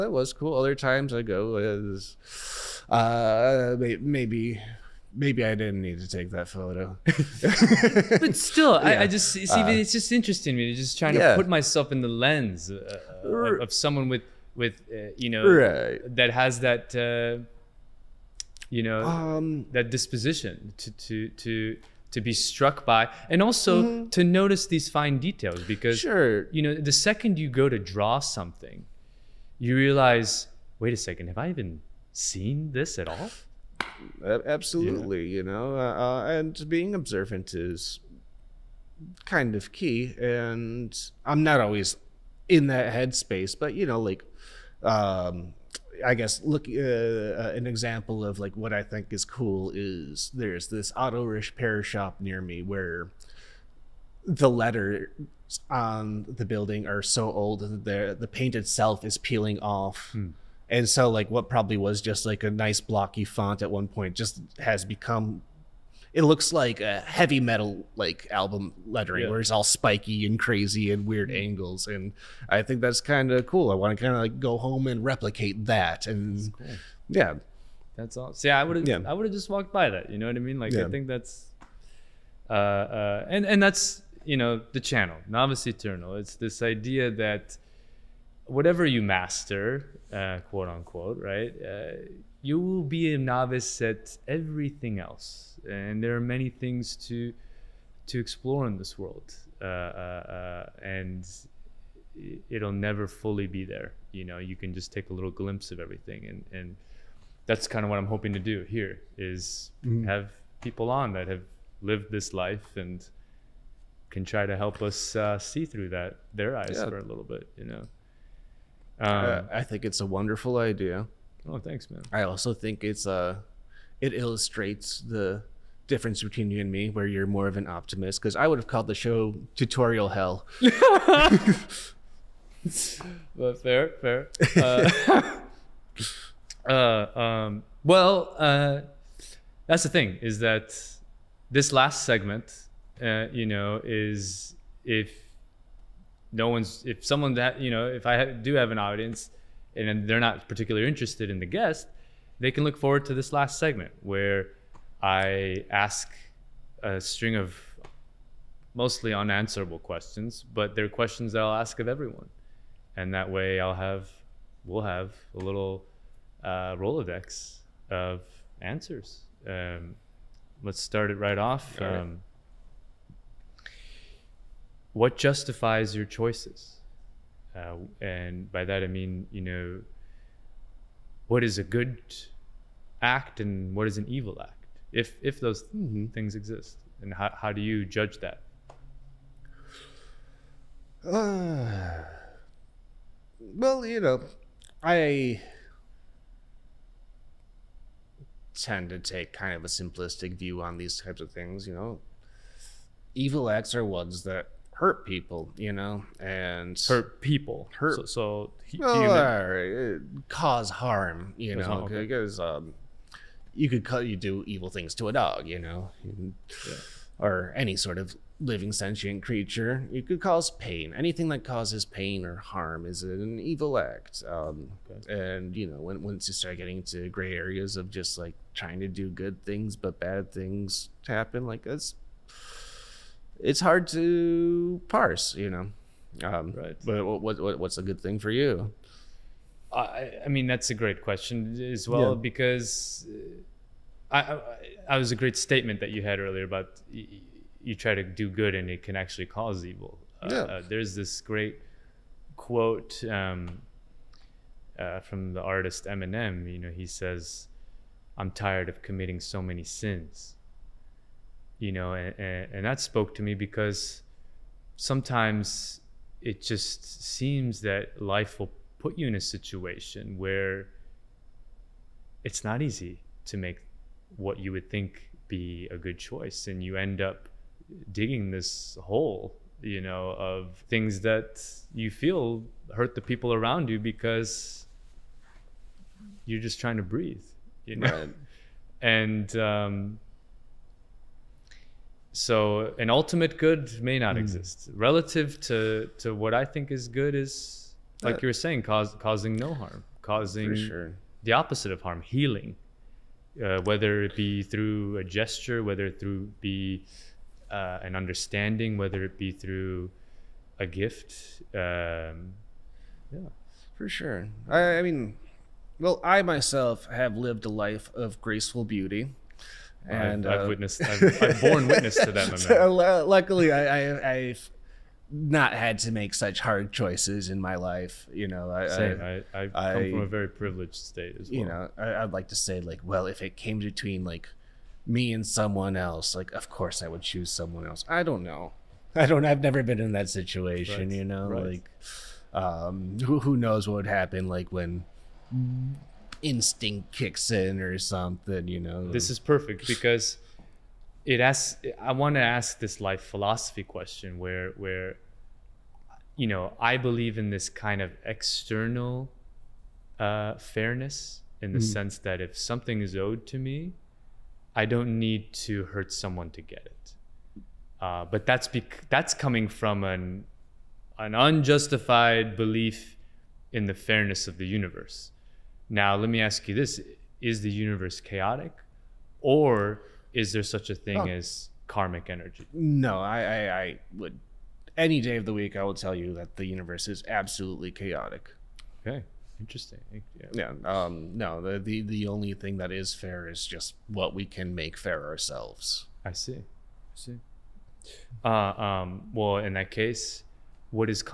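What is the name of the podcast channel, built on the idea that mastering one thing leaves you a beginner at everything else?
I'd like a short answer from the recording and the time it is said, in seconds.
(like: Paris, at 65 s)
Novice Eternal, at 85 s.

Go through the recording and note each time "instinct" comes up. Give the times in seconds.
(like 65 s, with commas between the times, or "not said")
346 s.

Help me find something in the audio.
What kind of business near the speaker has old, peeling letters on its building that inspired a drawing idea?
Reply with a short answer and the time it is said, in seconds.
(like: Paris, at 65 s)
Auto repair shop, at 50 s.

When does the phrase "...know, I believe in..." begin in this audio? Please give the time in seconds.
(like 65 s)
356 s.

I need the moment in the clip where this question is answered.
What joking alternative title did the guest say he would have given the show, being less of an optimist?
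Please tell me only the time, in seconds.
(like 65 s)
129 s.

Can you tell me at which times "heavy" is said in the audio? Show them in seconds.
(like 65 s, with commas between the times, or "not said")
67 s.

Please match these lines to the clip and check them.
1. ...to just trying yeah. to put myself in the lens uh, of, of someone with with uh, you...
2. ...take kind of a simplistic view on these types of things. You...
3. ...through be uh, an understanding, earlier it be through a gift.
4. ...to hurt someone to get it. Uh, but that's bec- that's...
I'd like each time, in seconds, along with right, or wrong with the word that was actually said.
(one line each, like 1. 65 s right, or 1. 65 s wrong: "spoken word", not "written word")
1. 10 s right
2. 198 s right
3. 305 s wrong: "whether", not "earlier"
4. 365 s right.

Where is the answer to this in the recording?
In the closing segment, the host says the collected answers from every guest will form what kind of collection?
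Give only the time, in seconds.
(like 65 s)
166 s.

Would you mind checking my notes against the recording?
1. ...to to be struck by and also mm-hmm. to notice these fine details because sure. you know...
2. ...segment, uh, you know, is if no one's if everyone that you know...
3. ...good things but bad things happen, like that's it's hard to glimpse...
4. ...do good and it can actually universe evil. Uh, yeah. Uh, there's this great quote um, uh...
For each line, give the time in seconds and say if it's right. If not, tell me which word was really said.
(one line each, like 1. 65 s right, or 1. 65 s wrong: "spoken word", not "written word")
1. 21 s right
2. 142 s wrong: "someone", not "everyone"
3. 229 s wrong: "parse", not "glimpse"
4. 248 s wrong: "cause", not "universe".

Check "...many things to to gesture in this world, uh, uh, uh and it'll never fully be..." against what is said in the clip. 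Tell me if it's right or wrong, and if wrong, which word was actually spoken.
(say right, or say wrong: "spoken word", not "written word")
wrong: "explore", not "gesture".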